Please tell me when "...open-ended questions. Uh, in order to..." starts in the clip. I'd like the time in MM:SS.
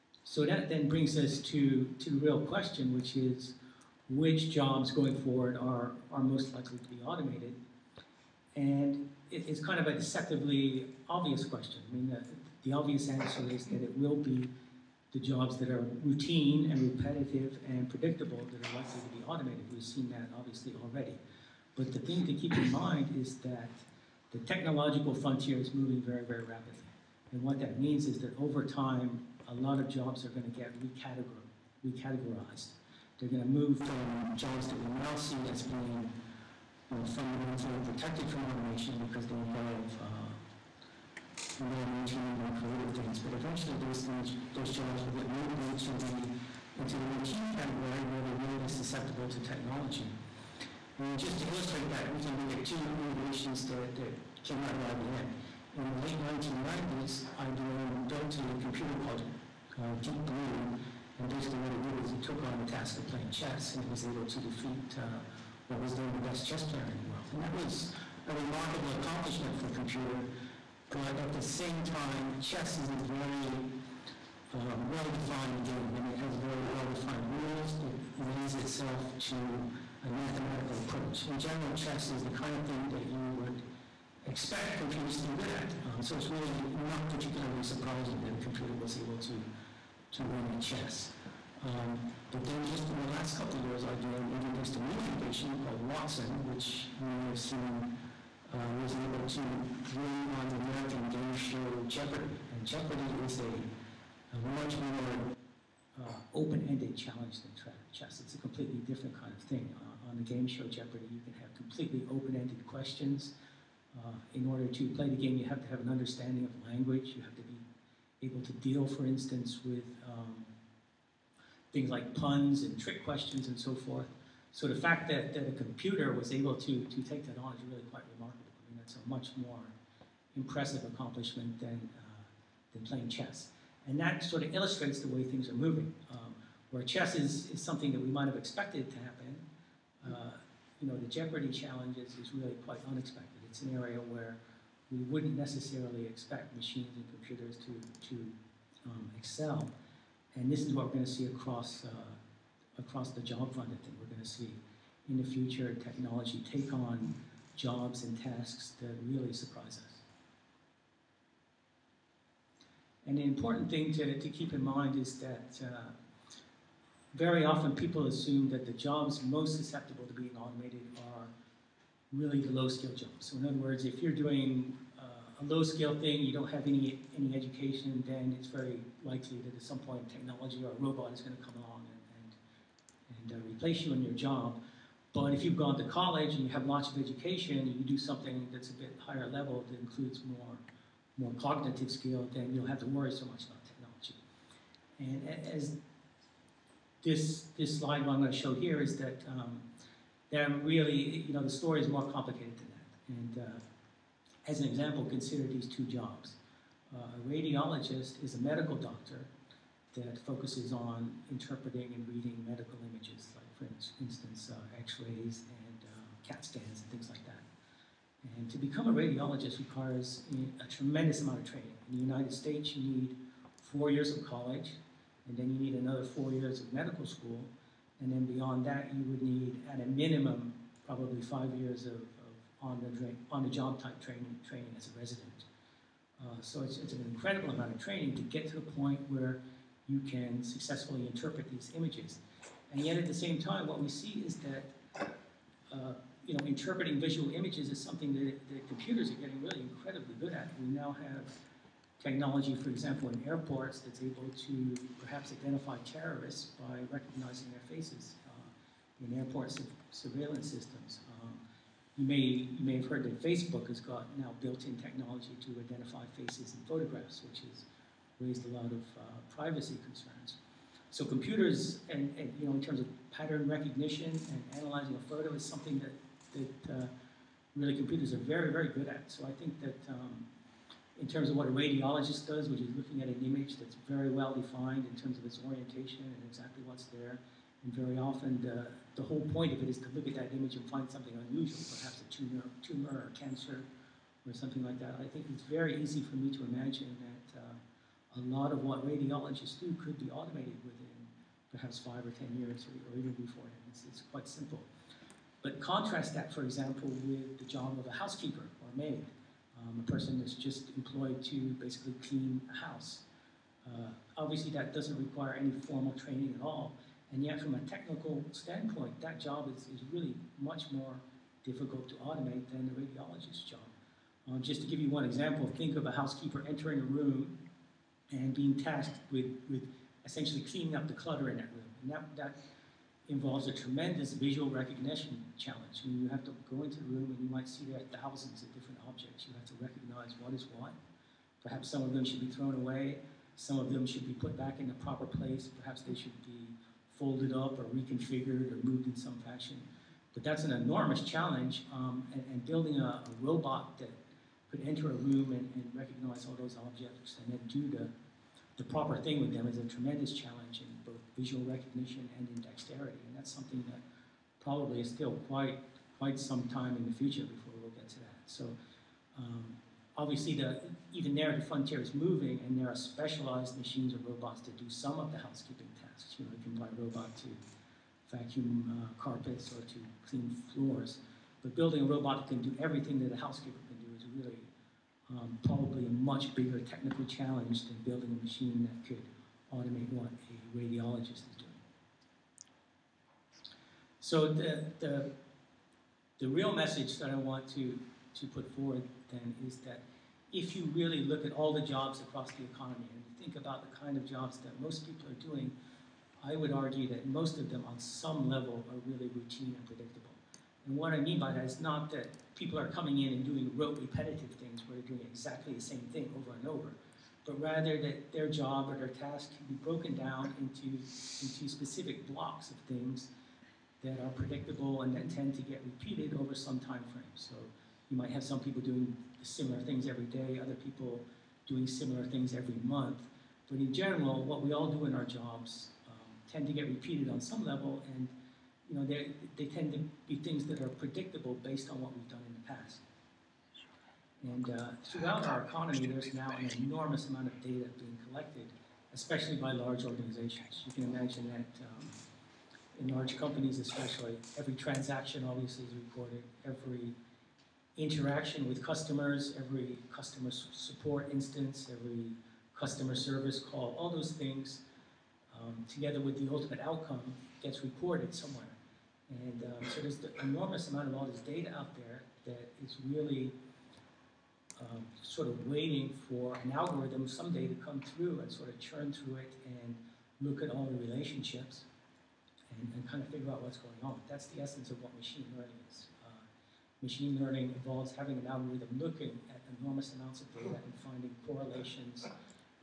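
01:52.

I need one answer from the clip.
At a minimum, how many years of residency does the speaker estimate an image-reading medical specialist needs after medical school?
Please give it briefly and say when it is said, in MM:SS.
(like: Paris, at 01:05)
5, at 03:51.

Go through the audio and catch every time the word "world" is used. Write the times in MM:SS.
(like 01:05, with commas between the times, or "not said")
01:07.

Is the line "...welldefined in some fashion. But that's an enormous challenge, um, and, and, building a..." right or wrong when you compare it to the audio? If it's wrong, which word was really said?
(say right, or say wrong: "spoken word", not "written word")
wrong: "moved", not "welldefined".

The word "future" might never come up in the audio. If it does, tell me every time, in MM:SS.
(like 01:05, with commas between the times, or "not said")
02:35, 06:06.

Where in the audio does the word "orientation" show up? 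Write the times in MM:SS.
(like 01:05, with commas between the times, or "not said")
04:45.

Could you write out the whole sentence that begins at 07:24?
And uh, throughout our economy, there's now an enormous amount of data being collected, especially by large organizations.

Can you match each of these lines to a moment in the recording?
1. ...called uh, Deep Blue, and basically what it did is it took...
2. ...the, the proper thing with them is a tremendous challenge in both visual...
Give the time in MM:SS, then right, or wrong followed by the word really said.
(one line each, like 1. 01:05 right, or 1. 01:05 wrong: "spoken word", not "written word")
1. 00:58 right
2. 05:57 right.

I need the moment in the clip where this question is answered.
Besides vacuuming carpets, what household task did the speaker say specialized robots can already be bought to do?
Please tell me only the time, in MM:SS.
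06:20.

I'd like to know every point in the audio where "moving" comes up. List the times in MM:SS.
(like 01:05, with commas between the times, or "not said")
00:25, 02:15, 06:11.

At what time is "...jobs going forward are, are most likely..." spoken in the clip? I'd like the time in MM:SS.
00:04.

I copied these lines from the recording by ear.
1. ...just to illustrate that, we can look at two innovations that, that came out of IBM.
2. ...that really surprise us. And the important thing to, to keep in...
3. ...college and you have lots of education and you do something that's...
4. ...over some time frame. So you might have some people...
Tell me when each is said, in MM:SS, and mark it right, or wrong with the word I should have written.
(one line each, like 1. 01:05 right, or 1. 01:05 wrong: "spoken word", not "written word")
1. 00:51 right
2. 02:38 right
3. 03:05 right
4. 07:06 right.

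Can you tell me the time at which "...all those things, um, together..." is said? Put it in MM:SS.
07:43.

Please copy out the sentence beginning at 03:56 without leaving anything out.
Uh, so it's, it's an incredible amount of training to get to the point where you can successfully interpret these images.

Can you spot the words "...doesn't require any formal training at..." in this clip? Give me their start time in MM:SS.
05:14.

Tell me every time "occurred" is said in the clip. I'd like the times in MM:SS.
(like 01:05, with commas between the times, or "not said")
not said.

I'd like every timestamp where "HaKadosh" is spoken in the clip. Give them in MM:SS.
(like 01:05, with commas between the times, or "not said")
not said.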